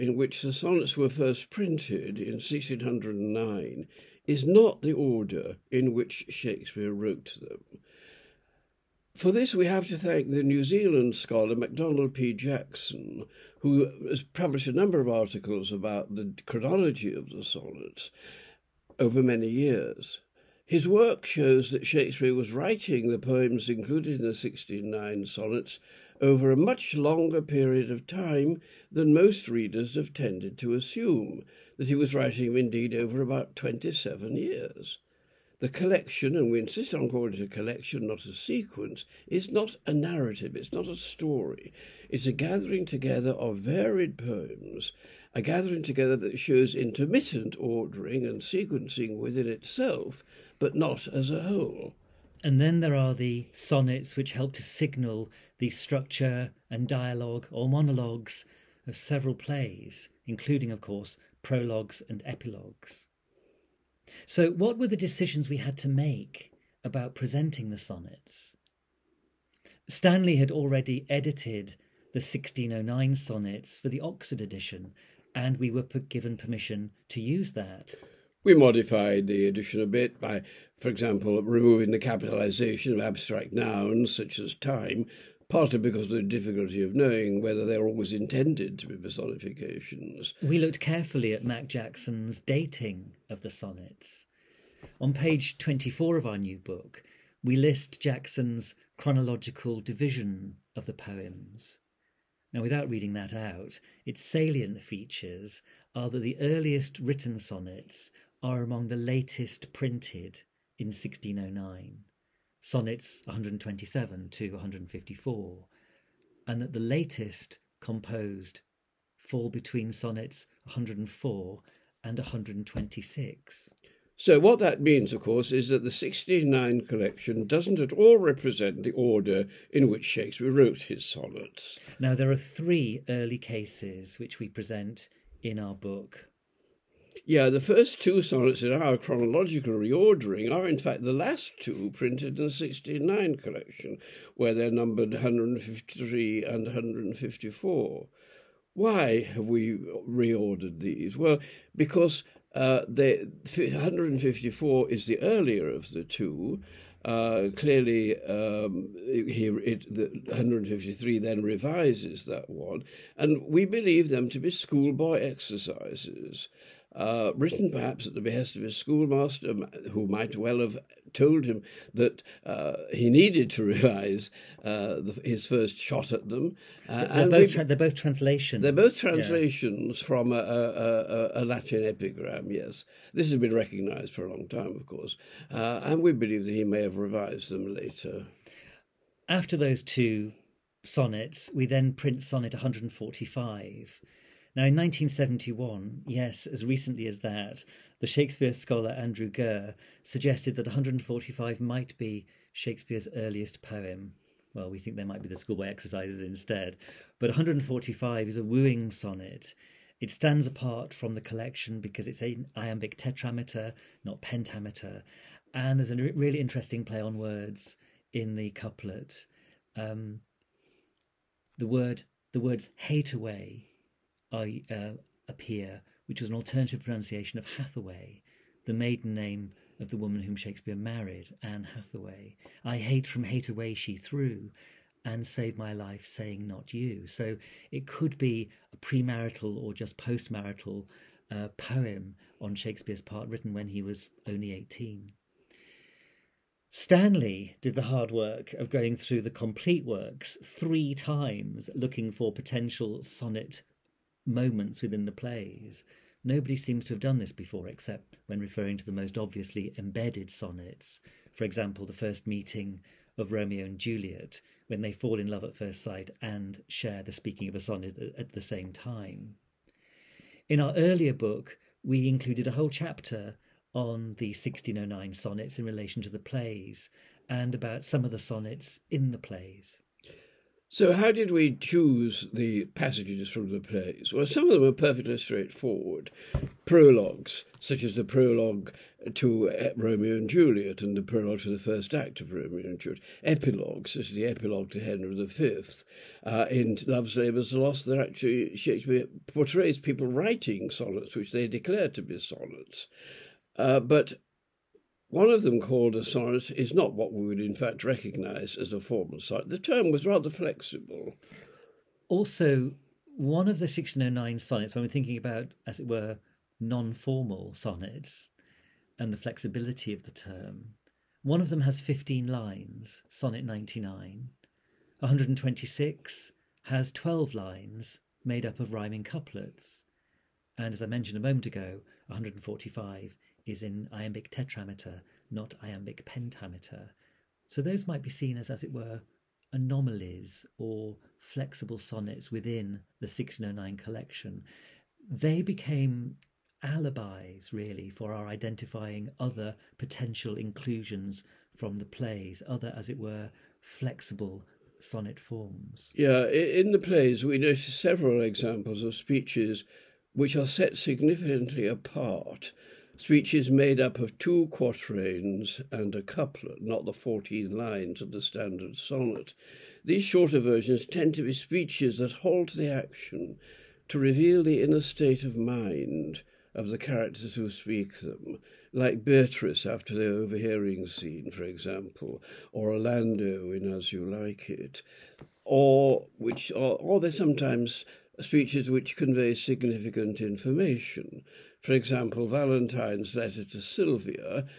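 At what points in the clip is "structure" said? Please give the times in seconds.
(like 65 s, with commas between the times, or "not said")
55 s.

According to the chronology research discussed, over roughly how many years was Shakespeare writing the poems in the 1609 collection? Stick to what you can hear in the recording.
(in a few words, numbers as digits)
27.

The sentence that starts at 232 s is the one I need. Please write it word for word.
I hate from hate away she threw, and save my life, saying not you.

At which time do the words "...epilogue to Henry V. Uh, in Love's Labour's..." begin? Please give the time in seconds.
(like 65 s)
294 s.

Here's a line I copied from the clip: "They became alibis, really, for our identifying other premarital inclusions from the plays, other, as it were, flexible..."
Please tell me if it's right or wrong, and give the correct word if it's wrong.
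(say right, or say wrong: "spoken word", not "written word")
wrong: "potential", not "premarital".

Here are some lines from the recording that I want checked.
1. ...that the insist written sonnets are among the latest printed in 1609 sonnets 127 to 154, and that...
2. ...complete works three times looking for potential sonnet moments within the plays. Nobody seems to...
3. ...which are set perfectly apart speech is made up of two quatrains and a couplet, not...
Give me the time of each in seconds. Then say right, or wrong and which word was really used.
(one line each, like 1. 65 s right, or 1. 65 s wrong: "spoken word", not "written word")
1. 106 s wrong: "earliest", not "insist"
2. 249 s right
3. 360 s wrong: "significantly", not "perfectly".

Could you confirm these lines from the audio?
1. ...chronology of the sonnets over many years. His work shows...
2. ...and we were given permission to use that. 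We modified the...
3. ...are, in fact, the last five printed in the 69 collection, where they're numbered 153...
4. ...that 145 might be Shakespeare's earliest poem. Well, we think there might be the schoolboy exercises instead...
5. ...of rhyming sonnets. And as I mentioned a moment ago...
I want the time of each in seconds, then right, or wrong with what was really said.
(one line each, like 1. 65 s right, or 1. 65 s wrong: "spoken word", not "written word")
1. 16 s right
2. 75 s right
3. 140 s wrong: "two", not "five"
4. 200 s right
5. 328 s wrong: "couplets", not "sonnets".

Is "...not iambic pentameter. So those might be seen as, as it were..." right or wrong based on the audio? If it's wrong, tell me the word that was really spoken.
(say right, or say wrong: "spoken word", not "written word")
right.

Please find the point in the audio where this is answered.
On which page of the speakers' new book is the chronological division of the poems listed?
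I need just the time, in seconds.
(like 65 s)
95 s.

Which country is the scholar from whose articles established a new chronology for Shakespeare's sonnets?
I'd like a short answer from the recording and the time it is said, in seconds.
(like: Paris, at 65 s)
New Zealand, at 10 s.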